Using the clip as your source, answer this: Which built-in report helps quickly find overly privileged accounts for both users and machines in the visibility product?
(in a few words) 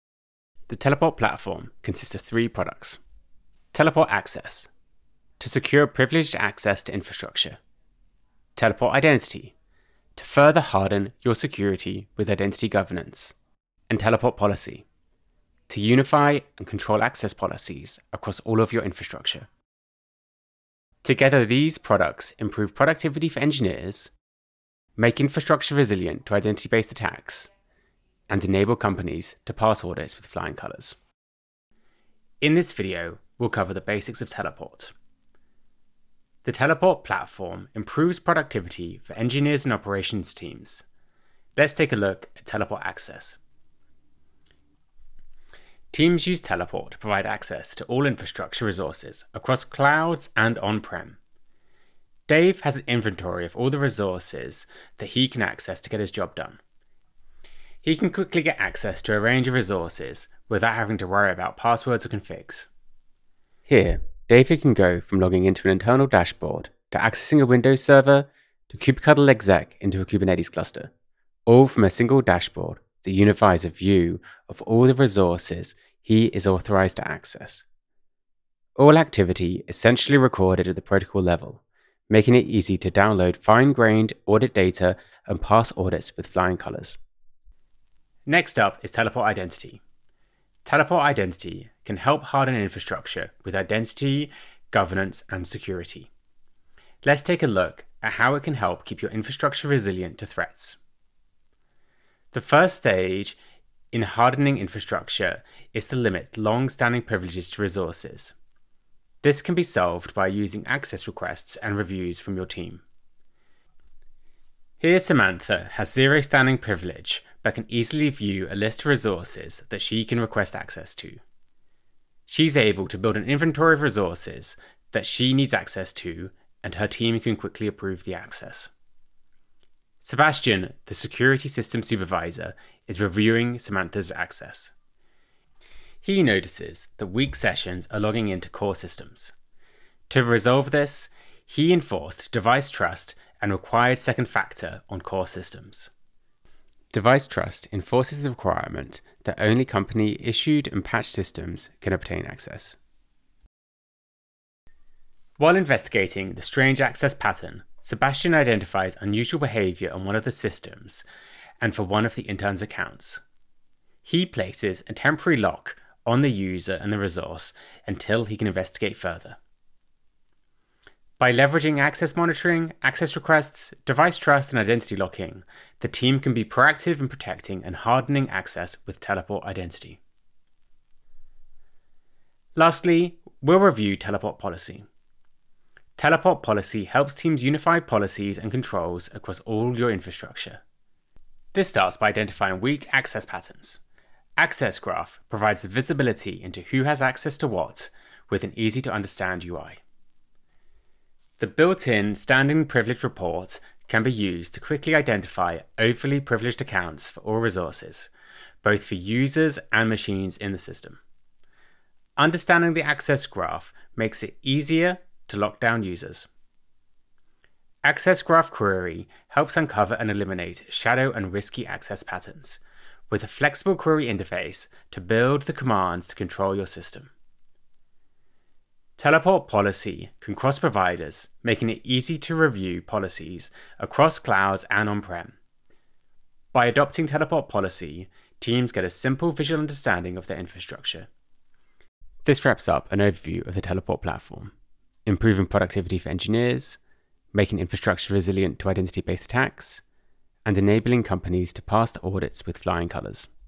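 standing privilege report.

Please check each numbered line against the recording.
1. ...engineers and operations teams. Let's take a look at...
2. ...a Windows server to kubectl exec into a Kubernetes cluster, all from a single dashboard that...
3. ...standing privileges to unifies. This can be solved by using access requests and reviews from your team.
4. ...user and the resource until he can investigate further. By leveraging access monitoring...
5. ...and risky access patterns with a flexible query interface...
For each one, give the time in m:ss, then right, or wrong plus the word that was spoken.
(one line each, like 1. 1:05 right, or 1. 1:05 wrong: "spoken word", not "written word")
1. 0:39 right
2. 1:07 right
3. 1:46 wrong: "resources", not "unifies"
4. 2:46 right
5. 3:41 right.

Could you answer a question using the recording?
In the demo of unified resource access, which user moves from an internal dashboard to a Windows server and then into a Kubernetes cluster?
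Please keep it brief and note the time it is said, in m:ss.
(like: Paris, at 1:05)
David, at 1:04.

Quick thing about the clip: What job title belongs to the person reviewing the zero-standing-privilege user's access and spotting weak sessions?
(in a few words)
security system supervisor.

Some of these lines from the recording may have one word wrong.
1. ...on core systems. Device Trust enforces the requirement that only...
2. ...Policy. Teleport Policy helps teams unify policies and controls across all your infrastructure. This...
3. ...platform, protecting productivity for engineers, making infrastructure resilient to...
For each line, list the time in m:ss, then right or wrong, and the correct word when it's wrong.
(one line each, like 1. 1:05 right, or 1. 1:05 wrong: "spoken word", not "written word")
1. 2:24 right
2. 3:04 right
3. 4:04 wrong: "improving", not "protecting".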